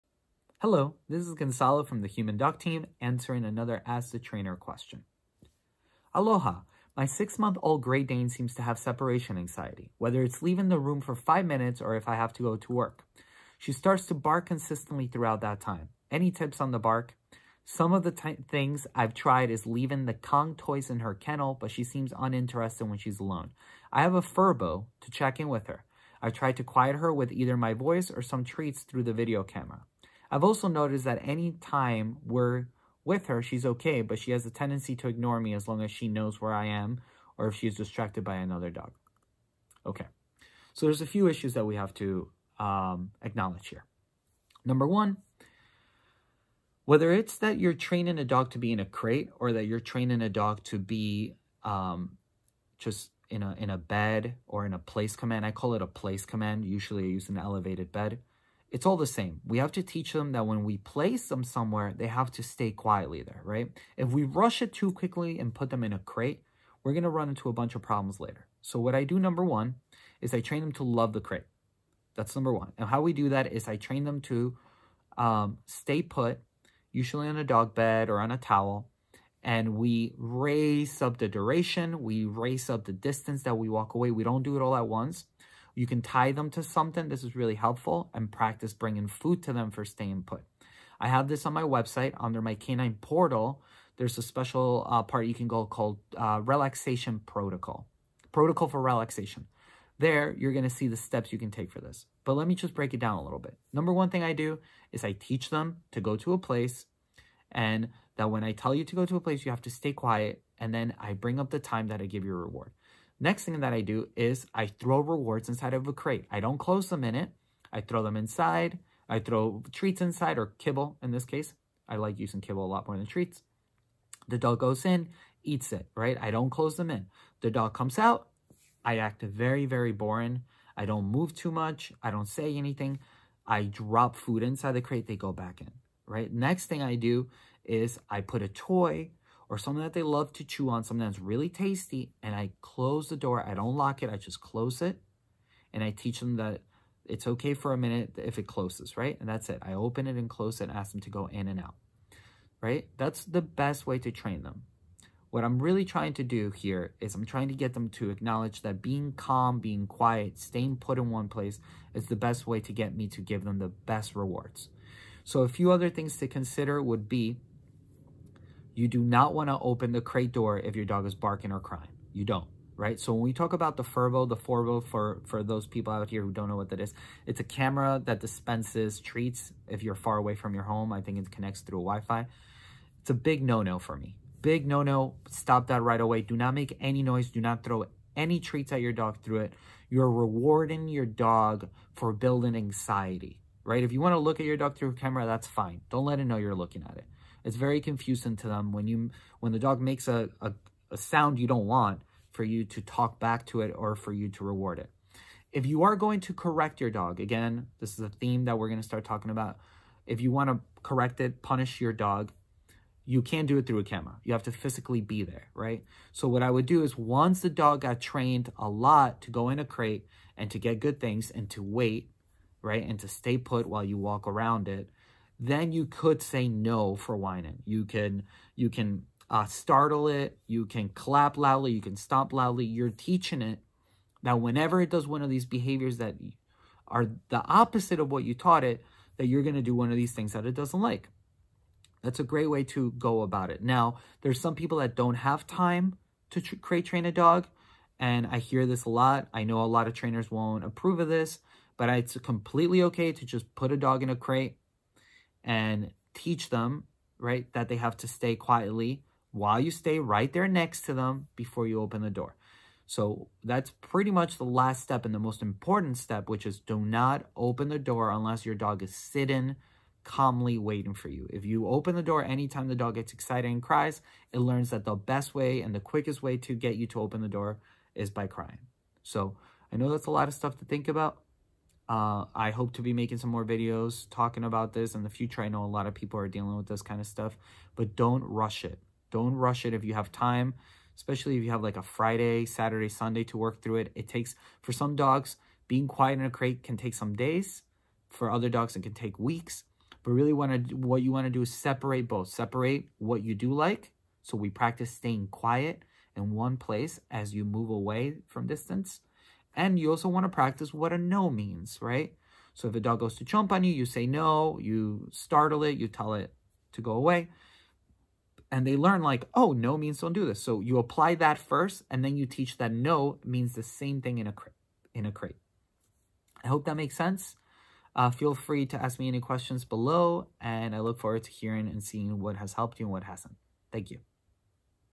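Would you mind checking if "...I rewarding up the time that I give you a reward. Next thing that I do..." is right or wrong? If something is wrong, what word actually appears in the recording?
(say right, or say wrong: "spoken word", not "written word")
wrong: "bring", not "rewarding".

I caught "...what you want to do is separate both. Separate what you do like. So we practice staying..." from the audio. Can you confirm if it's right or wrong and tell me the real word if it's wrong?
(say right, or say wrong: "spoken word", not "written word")
right.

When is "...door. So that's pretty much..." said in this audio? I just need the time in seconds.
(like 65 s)
262 s.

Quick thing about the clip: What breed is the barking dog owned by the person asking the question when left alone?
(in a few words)
Great Dane.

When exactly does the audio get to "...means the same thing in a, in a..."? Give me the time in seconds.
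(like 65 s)
323 s.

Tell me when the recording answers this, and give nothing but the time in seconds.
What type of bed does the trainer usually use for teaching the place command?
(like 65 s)
57 s.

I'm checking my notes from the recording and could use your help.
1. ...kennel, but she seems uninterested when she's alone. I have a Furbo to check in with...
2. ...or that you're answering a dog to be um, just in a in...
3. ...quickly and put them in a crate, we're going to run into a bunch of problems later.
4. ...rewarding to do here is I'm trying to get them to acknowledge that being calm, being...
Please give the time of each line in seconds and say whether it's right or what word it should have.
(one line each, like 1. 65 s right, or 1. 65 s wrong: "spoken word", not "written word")
1. 21 s right
2. 49 s wrong: "training", not "answering"
3. 64 s right
4. 155 s wrong: "trying", not "rewarding".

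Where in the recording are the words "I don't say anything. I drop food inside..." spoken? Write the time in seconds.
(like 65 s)
132 s.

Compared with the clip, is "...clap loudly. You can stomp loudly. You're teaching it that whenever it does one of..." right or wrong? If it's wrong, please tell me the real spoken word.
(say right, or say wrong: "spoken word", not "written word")
right.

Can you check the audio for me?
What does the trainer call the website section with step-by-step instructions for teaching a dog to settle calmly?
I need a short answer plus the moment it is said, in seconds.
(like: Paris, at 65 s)
relaxation protocol, at 96 s.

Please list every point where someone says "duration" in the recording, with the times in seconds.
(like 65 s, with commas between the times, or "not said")
81 s.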